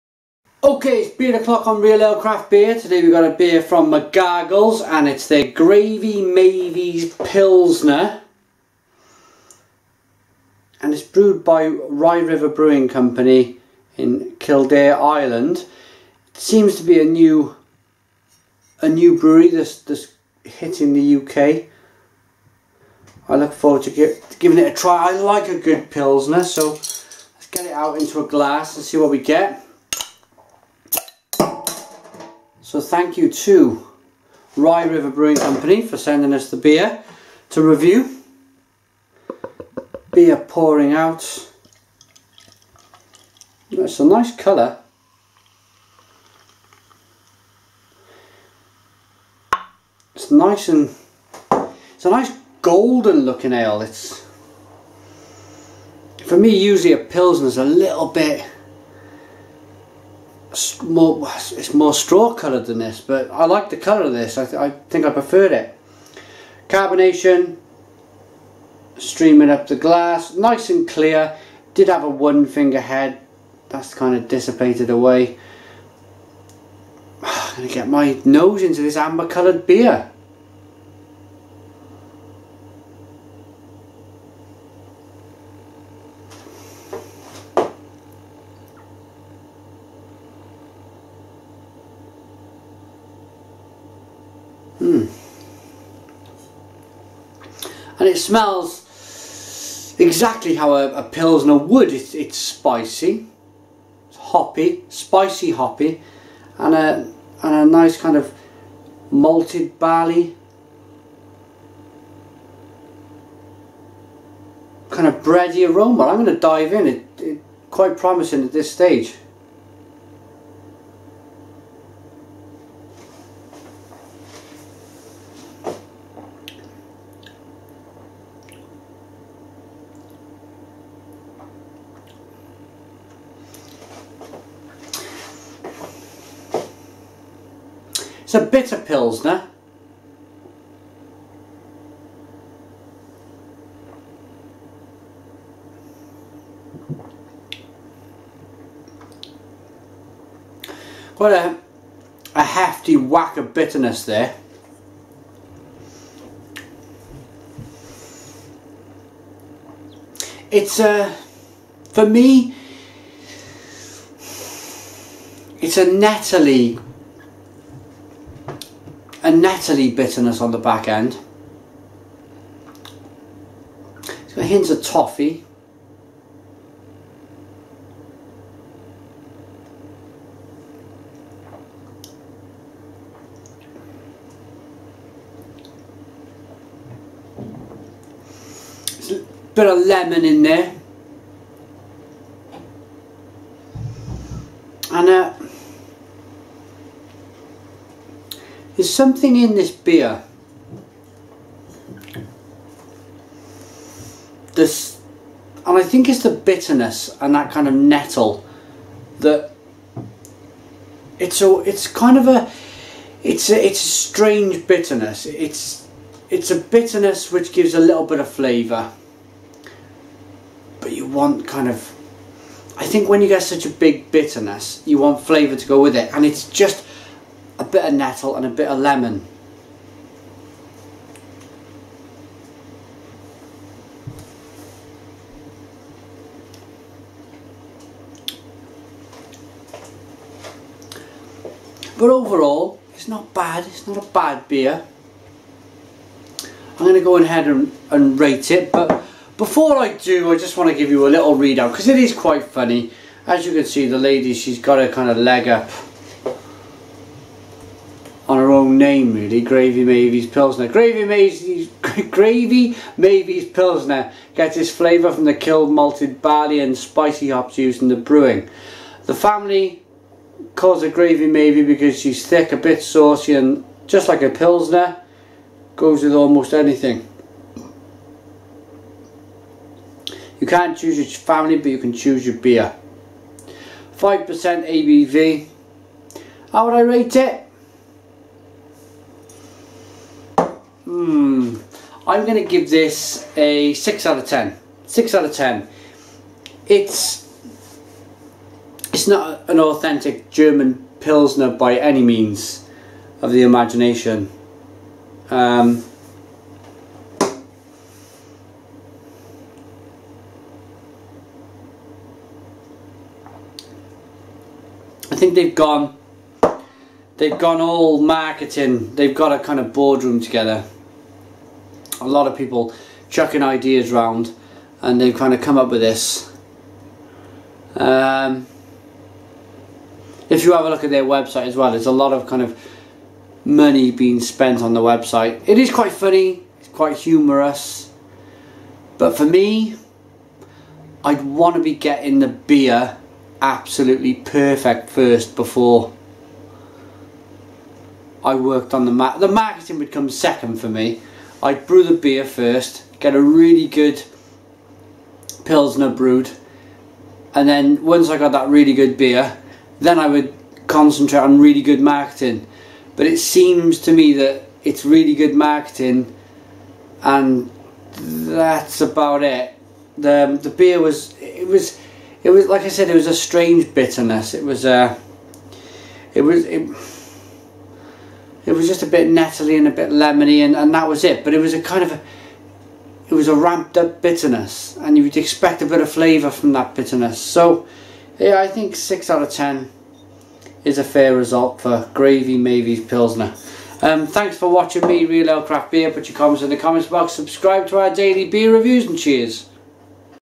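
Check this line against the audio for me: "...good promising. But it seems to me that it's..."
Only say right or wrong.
wrong.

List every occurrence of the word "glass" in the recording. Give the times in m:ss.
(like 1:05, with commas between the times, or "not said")
0:28, 1:09.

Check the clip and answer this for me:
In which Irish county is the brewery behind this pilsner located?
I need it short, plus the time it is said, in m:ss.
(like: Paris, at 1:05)
Kildare, at 0:14.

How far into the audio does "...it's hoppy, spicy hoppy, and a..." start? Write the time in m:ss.
1:44.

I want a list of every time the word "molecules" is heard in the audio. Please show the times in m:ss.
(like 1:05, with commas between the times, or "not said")
not said.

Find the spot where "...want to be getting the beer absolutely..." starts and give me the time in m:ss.
5:41.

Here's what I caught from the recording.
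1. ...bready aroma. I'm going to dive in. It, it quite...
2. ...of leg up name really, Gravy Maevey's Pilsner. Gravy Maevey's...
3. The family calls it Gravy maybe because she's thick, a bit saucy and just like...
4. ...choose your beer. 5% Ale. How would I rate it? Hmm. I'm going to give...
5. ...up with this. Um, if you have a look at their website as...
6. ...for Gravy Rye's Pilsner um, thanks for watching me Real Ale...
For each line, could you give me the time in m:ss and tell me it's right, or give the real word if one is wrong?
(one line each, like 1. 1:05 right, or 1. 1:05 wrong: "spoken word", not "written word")
1. 1:55 right
2. 4:15 right
3. 4:29 right
4. 4:41 wrong: "ABV", not "Ale"
5. 5:25 right
6. 6:31 wrong: "Maevey", not "Rye".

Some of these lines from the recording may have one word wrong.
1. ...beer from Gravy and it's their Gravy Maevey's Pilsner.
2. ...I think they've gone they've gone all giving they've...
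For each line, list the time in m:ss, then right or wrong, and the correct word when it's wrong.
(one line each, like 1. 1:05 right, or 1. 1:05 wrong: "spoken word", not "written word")
1. 0:03 wrong: "McGargles", not "Gravy"
2. 5:15 wrong: "marketing", not "giving".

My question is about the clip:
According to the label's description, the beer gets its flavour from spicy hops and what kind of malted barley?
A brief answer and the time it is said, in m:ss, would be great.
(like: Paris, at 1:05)
Kilned, at 4:25.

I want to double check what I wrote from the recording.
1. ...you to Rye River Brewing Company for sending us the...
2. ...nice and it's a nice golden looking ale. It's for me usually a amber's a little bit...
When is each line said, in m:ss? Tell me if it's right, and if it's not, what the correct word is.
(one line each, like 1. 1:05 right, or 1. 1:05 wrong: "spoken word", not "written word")
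1. 0:33 right
2. 0:50 wrong: "pilsner", not "amber".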